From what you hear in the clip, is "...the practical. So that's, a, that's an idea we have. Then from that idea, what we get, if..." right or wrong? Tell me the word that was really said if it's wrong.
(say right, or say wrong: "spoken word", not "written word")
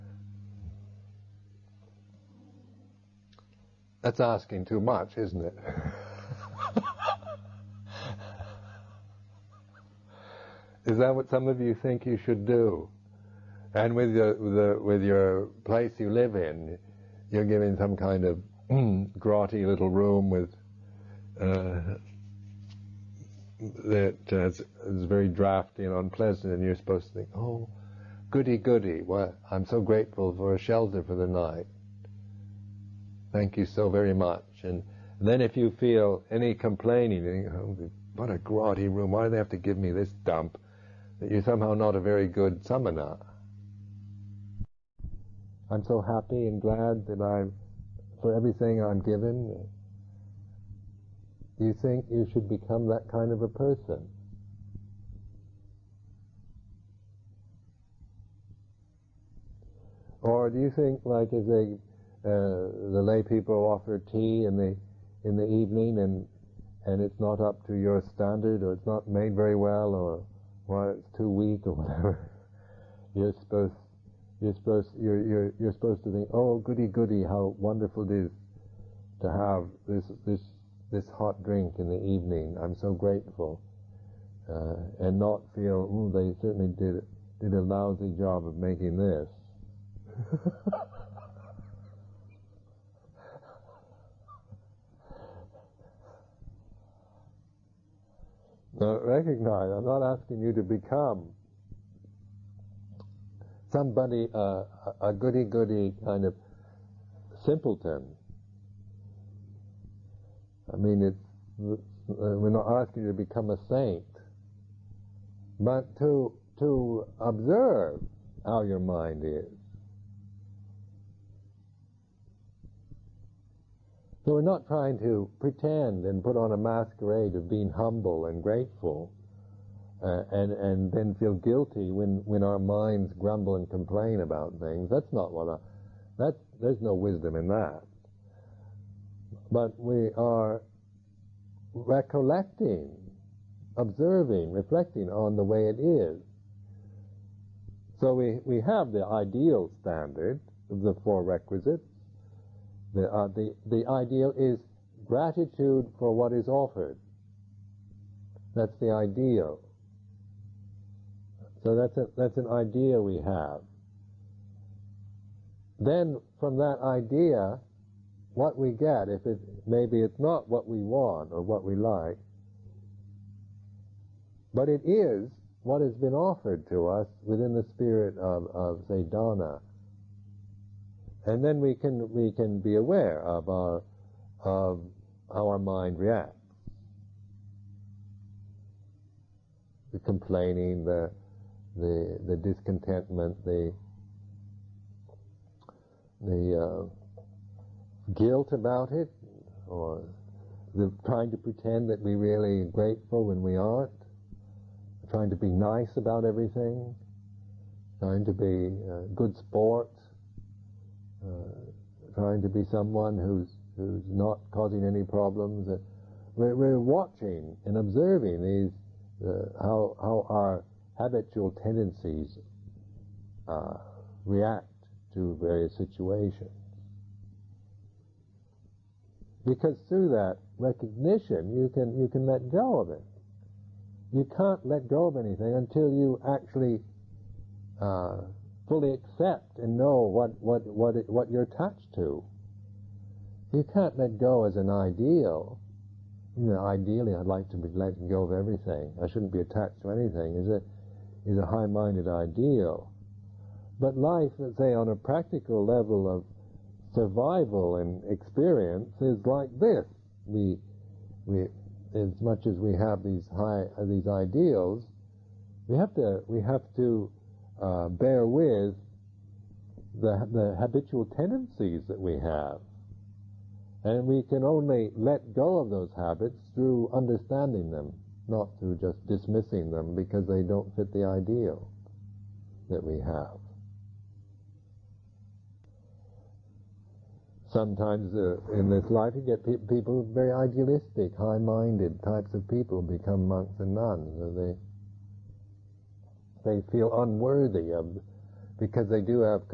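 wrong: "ideal", not "practical".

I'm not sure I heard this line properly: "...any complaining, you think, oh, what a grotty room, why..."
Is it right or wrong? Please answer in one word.
right.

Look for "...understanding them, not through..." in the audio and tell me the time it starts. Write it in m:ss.
4:36.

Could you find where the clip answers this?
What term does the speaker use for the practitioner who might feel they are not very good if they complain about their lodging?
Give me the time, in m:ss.
0:42.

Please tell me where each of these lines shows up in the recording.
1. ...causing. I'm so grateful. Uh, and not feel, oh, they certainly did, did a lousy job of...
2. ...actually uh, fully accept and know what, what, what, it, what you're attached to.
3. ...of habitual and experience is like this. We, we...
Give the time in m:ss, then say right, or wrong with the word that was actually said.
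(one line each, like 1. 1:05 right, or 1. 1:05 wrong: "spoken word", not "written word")
1. 1:21 wrong: "evening", not "causing"
2. 3:56 right
3. 4:16 wrong: "survival", not "habitual".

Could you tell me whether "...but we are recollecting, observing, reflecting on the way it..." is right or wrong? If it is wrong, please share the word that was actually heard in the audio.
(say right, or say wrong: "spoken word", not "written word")
right.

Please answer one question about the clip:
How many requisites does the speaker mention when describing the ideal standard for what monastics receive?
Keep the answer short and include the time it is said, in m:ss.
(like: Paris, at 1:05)
4, at 2:31.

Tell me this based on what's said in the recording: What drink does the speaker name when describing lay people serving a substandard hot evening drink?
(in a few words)
Tea.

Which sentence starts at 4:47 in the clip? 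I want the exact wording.
sometimes uh, in this life you get pe- people very idealistic, high-minded types of people become monks and nuns.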